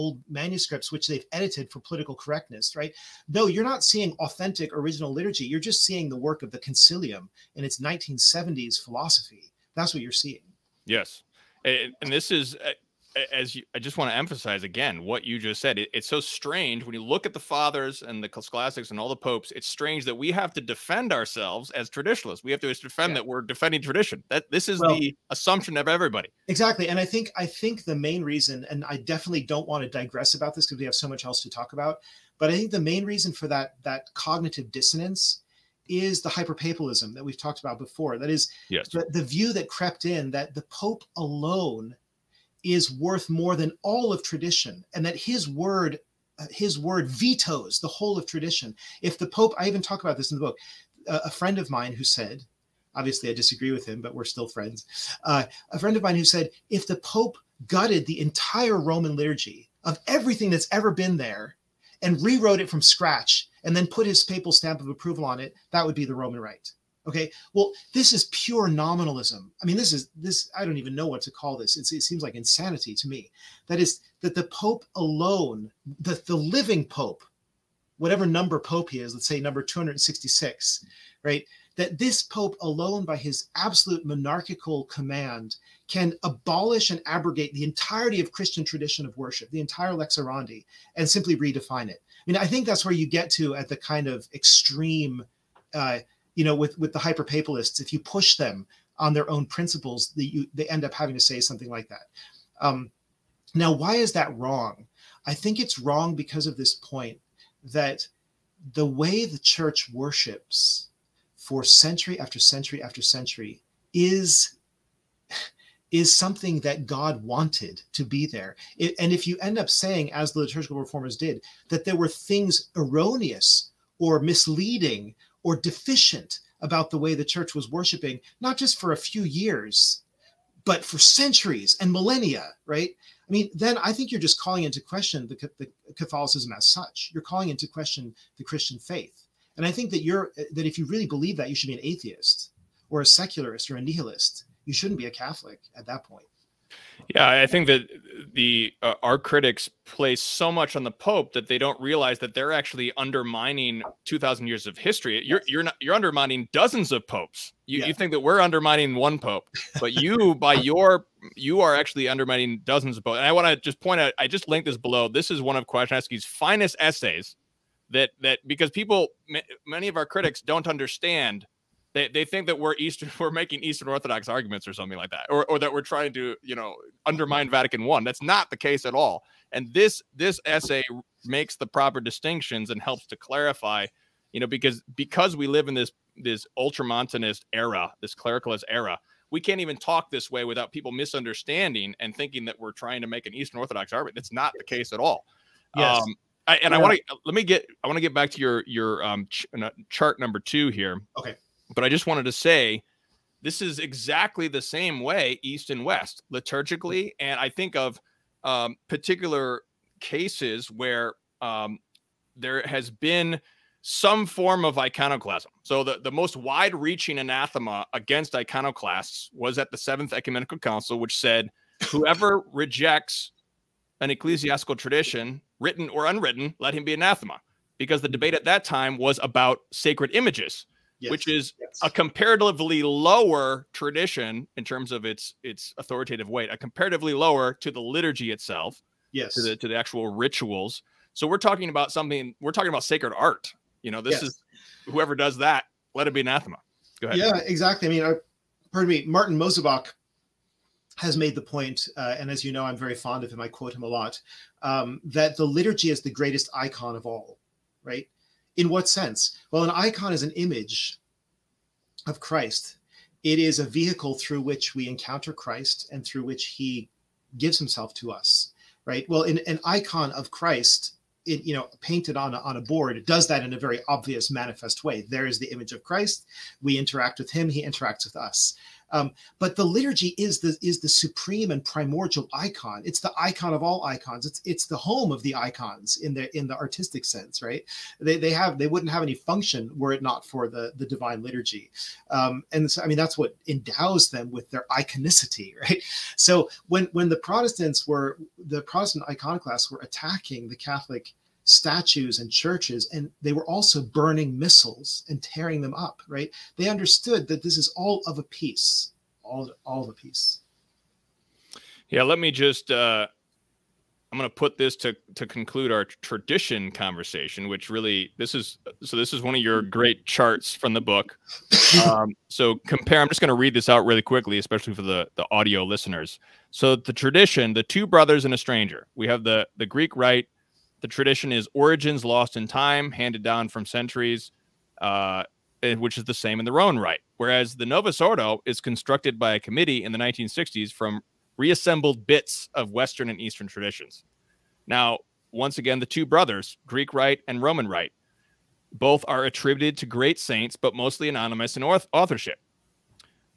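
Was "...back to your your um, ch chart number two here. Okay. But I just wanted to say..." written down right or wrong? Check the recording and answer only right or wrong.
right.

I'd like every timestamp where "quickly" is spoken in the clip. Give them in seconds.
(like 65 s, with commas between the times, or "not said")
324 s.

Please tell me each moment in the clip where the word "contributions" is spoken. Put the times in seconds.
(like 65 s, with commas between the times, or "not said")
not said.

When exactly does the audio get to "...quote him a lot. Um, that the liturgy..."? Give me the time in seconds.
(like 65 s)
253 s.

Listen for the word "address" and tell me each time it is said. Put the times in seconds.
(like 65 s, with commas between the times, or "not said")
not said.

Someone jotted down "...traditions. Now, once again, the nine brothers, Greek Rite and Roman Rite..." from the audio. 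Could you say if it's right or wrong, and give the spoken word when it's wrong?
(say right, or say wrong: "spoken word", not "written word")
wrong: "two", not "nine".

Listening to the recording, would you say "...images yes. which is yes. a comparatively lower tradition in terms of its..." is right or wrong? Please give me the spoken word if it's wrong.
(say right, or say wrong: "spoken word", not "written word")
right.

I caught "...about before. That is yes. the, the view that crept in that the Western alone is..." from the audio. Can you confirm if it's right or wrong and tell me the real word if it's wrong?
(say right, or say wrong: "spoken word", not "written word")
wrong: "Pope", not "Western".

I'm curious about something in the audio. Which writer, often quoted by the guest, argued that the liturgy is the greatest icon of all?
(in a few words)
Martin Mosebach.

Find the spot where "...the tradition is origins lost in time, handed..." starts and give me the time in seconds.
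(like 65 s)
330 s.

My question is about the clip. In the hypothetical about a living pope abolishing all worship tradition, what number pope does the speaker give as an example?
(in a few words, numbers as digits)
266.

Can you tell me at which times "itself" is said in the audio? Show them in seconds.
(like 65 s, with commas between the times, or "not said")
238 s.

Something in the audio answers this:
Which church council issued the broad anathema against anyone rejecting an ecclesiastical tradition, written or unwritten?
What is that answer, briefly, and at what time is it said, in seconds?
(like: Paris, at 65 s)
Seventh Ecumenical Council, at 219 s.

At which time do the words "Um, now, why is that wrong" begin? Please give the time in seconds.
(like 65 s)
102 s.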